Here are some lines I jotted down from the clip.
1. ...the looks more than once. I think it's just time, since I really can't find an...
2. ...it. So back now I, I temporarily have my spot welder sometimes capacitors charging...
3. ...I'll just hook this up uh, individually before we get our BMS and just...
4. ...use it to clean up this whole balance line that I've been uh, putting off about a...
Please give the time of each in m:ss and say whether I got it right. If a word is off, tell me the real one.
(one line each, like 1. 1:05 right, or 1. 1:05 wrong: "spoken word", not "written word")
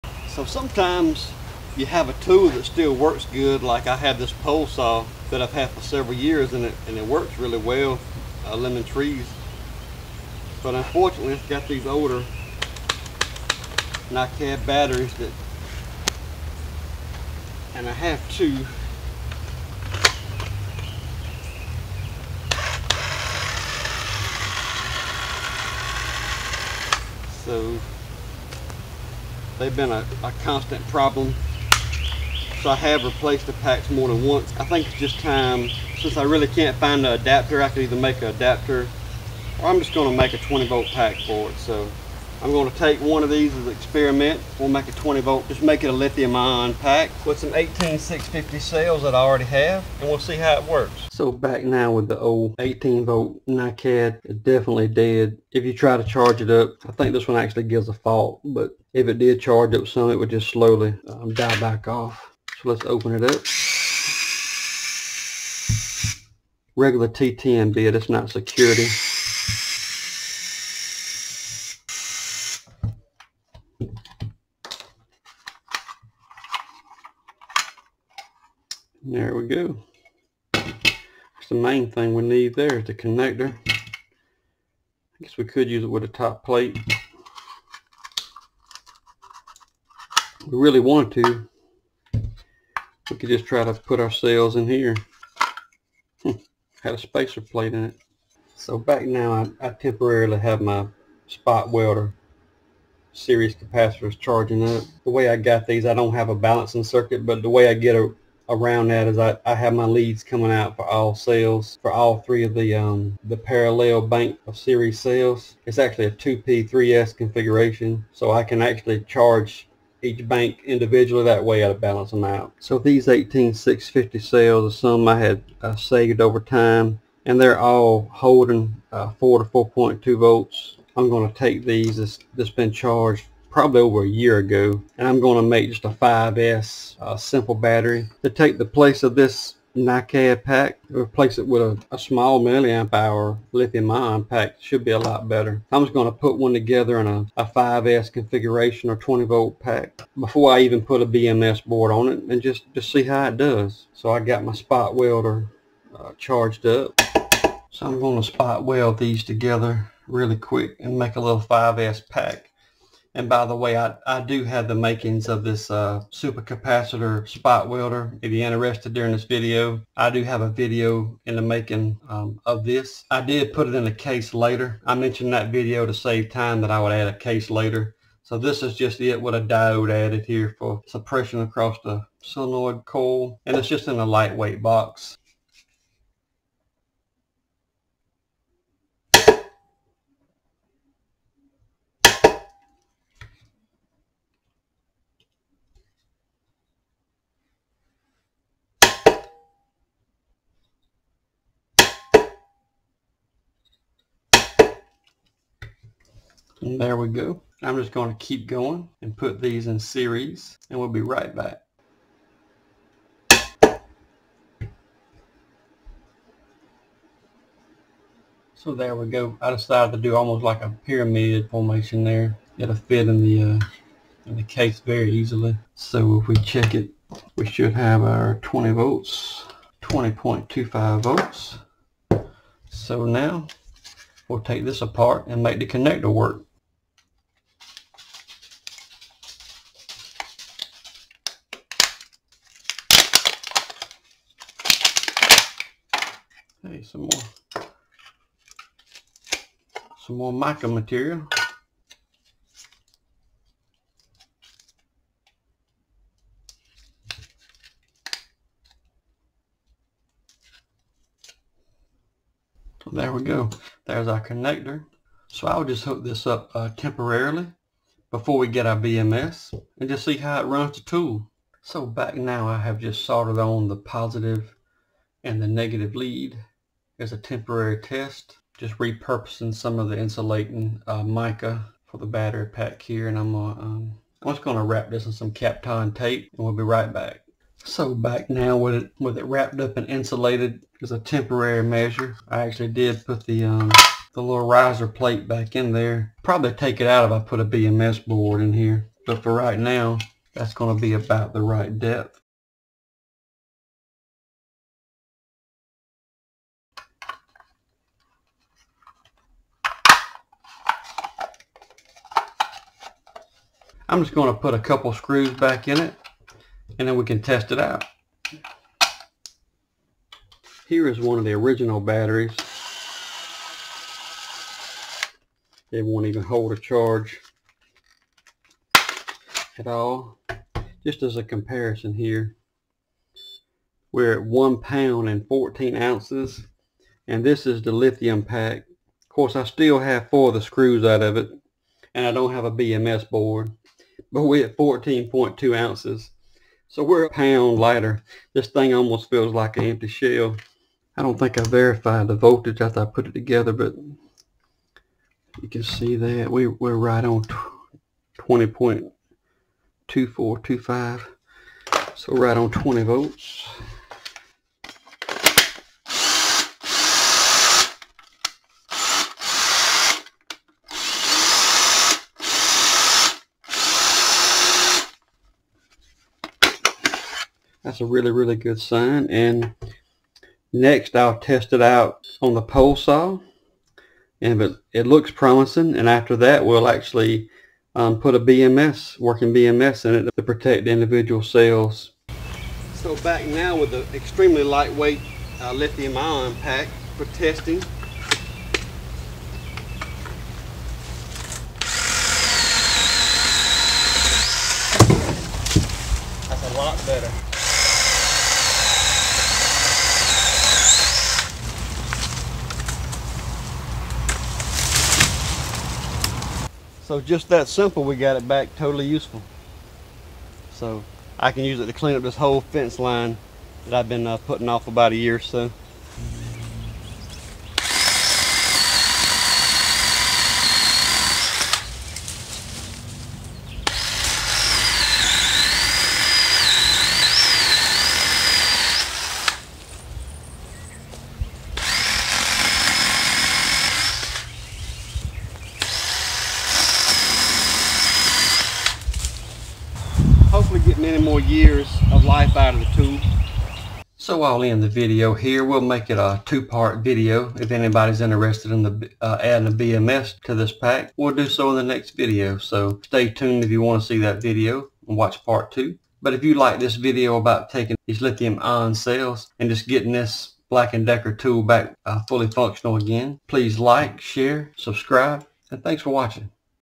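1. 0:33 wrong: "packs", not "looks"
2. 1:37 wrong: "series", not "sometimes"
3. 4:25 wrong: "temporarily", not "individually"
4. 7:01 wrong: "fence", not "balance".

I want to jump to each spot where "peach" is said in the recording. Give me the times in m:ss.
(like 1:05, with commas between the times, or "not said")
not said.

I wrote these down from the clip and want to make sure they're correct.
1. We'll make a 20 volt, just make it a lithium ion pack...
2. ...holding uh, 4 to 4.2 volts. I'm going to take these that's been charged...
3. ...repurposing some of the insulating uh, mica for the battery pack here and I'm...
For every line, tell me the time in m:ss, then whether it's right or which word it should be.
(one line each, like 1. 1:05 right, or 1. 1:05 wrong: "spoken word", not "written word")
1. 0:44 right
2. 2:08 right
3. 4:38 right.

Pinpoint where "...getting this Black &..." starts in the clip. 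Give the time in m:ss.
7:49.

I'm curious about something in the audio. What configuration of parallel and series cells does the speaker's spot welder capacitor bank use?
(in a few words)
2P3S.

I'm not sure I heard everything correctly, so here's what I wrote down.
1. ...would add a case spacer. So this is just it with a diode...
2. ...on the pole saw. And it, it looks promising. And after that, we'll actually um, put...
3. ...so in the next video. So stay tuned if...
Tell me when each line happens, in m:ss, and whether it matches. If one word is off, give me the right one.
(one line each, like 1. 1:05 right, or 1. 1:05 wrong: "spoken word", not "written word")
1. 2:56 wrong: "later", not "spacer"
2. 6:22 right
3. 7:41 right.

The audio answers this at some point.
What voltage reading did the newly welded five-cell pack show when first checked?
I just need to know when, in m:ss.
3:49.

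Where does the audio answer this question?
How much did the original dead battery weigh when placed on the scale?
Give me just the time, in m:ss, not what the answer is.
5:34.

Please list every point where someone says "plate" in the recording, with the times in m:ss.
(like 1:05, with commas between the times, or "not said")
1:26, 1:37, 4:54.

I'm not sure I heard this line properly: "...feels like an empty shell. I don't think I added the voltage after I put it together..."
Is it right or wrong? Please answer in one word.
wrong.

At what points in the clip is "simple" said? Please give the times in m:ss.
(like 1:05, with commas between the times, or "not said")
2:17, 6:57.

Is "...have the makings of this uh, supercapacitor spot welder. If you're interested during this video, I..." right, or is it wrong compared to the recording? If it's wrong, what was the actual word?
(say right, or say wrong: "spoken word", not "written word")
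right.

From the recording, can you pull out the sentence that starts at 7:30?
hopefully get more years of life out of the tube.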